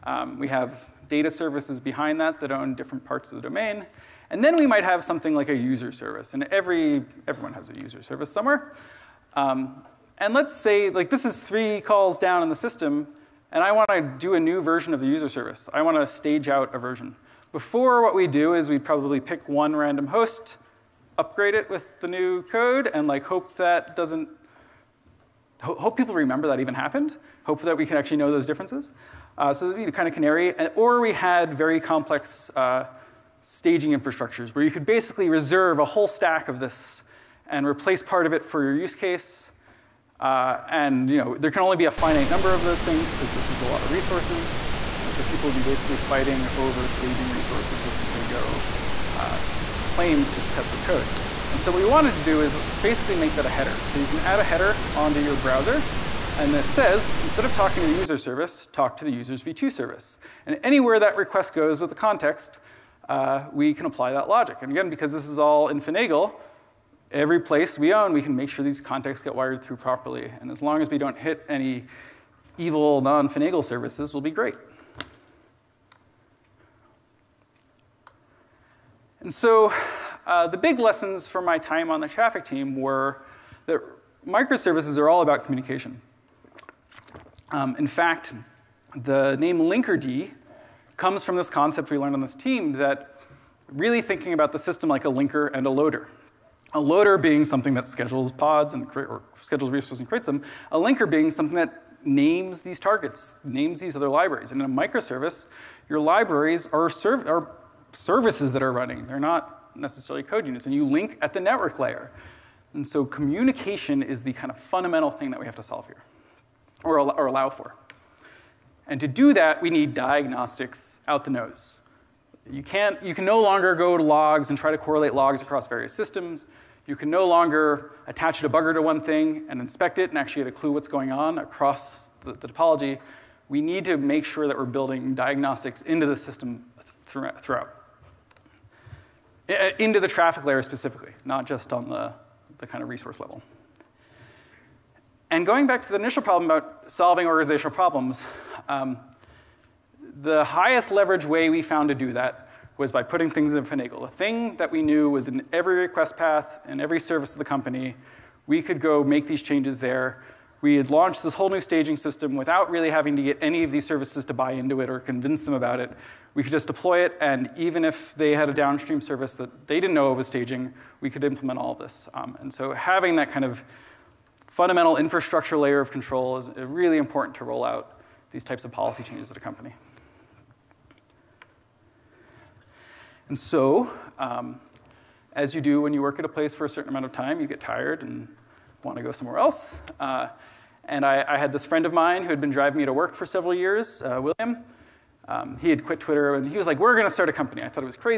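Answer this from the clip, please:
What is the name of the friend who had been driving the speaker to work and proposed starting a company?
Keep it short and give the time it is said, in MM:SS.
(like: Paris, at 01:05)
William, at 03:14.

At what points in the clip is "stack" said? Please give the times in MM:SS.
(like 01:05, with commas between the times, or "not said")
00:36.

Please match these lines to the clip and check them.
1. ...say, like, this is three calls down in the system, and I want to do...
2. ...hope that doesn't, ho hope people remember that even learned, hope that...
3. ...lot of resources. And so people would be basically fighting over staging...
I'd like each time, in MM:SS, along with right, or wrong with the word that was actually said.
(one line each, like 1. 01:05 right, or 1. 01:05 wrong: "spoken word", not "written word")
1. 00:10 right
2. 00:23 wrong: "happened", not "learned"
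3. 00:43 right.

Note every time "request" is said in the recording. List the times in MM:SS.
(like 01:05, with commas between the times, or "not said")
01:01, 02:35.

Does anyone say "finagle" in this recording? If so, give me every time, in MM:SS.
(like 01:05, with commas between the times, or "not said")
01:05, 01:13, 02:33.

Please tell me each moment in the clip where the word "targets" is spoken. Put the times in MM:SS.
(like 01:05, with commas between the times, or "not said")
01:42.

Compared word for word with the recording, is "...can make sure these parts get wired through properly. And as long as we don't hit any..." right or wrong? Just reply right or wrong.
wrong.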